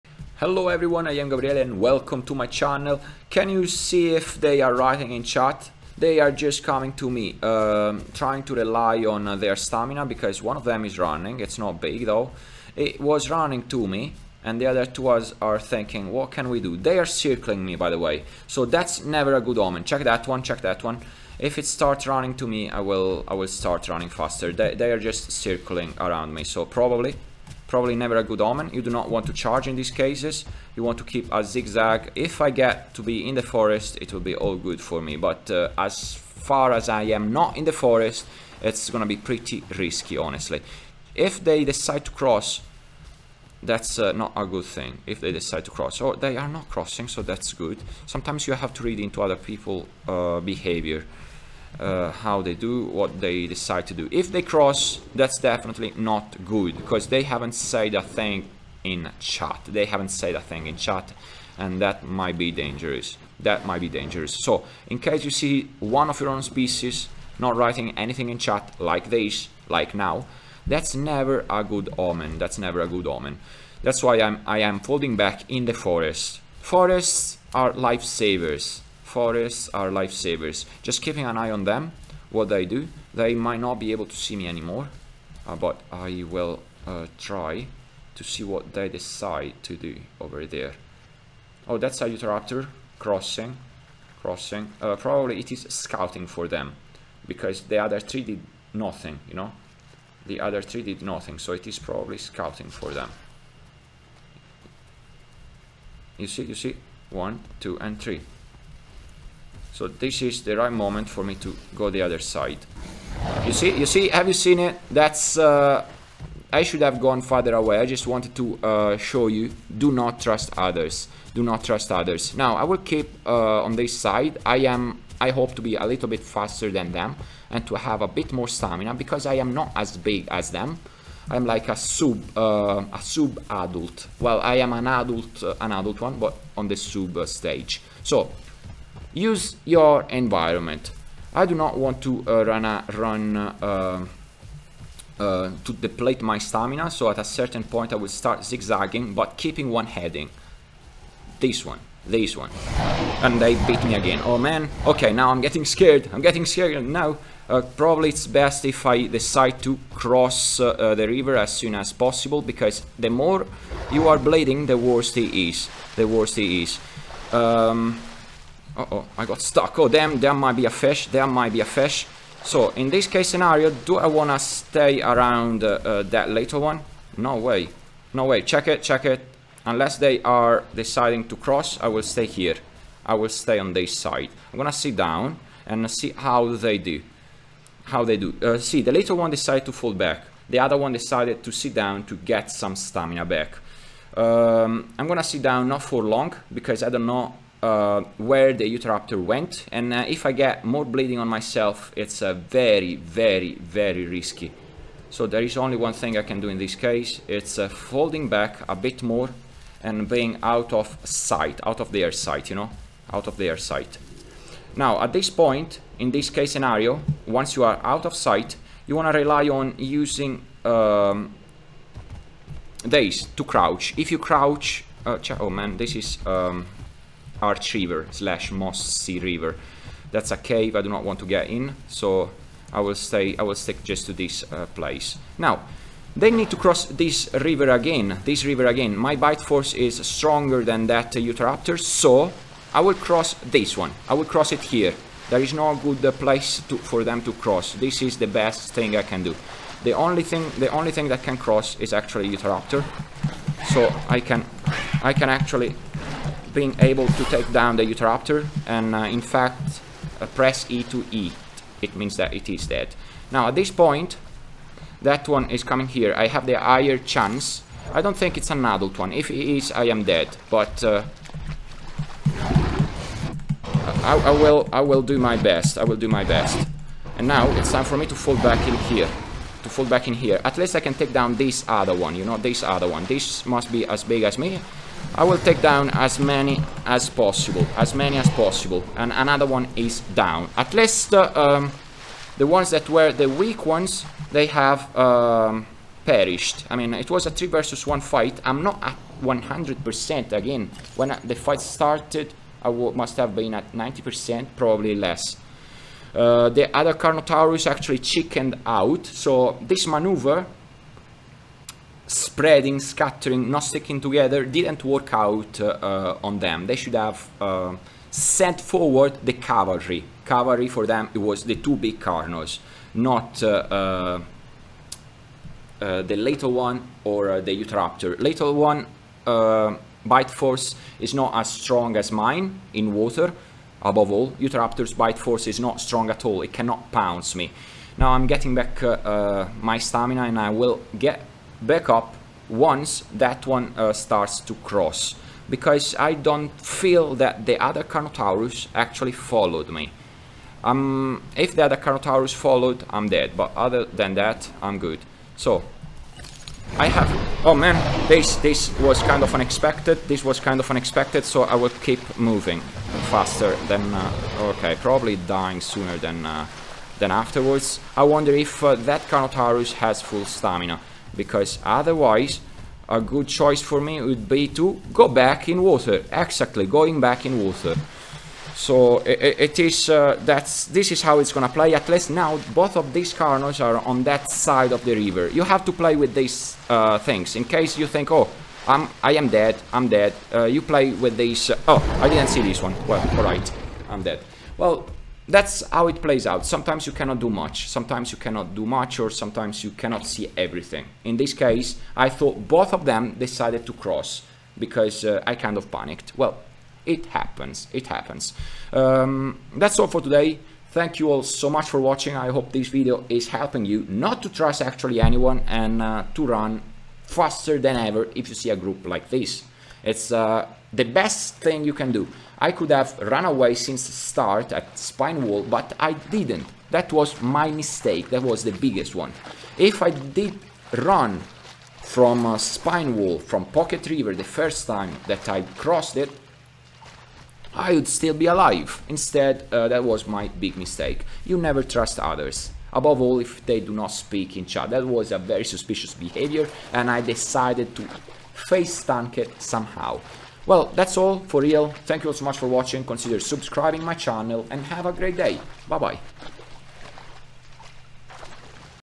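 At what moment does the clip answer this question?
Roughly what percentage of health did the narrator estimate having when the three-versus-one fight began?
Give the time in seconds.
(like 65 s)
303 s.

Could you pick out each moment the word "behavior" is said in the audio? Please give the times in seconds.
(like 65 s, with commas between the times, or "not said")
50 s, 445 s.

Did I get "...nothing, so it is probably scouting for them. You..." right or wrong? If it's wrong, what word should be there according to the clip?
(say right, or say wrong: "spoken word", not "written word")
right.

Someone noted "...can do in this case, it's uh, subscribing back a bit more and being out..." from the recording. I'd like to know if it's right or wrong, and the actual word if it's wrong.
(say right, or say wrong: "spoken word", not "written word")
wrong: "folding", not "subscribing".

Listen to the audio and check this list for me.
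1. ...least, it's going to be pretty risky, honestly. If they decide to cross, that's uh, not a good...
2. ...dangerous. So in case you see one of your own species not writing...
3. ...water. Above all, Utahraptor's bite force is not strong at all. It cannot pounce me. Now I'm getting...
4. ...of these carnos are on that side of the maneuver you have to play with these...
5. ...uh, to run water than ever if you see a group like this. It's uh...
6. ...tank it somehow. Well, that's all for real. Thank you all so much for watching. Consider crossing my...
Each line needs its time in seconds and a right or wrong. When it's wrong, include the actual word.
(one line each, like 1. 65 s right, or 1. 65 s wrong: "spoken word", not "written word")
1. 37 s wrong: "forest", not "least"
2. 63 s right
3. 332 s right
4. 382 s wrong: "river", not "maneuver"
5. 415 s wrong: "faster", not "water"
6. 448 s wrong: "subscribing", not "crossing".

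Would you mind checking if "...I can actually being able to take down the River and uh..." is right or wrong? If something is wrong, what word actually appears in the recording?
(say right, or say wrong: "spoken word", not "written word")
wrong: "Utahraptor", not "River".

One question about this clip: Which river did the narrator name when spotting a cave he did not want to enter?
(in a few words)
Arch River slash Mossy River.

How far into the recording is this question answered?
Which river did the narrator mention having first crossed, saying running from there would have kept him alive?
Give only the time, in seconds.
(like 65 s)
433 s.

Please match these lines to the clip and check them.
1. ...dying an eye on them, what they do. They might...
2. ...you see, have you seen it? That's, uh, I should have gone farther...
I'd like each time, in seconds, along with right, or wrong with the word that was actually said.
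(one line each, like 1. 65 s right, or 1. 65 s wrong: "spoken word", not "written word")
1. 81 s wrong: "keeping", not "dying"
2. 113 s right.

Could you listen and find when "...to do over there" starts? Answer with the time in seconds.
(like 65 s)
89 s.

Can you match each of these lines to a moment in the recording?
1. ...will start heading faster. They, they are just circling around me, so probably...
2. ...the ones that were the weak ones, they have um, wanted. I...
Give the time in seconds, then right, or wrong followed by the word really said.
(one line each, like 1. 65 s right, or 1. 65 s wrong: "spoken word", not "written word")
1. 23 s wrong: "running", not "heading"
2. 292 s wrong: "perished", not "wanted".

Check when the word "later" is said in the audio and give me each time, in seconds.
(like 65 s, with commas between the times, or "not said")
176 s, 188 s, 326 s.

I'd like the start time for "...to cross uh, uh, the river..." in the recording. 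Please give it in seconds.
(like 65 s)
159 s.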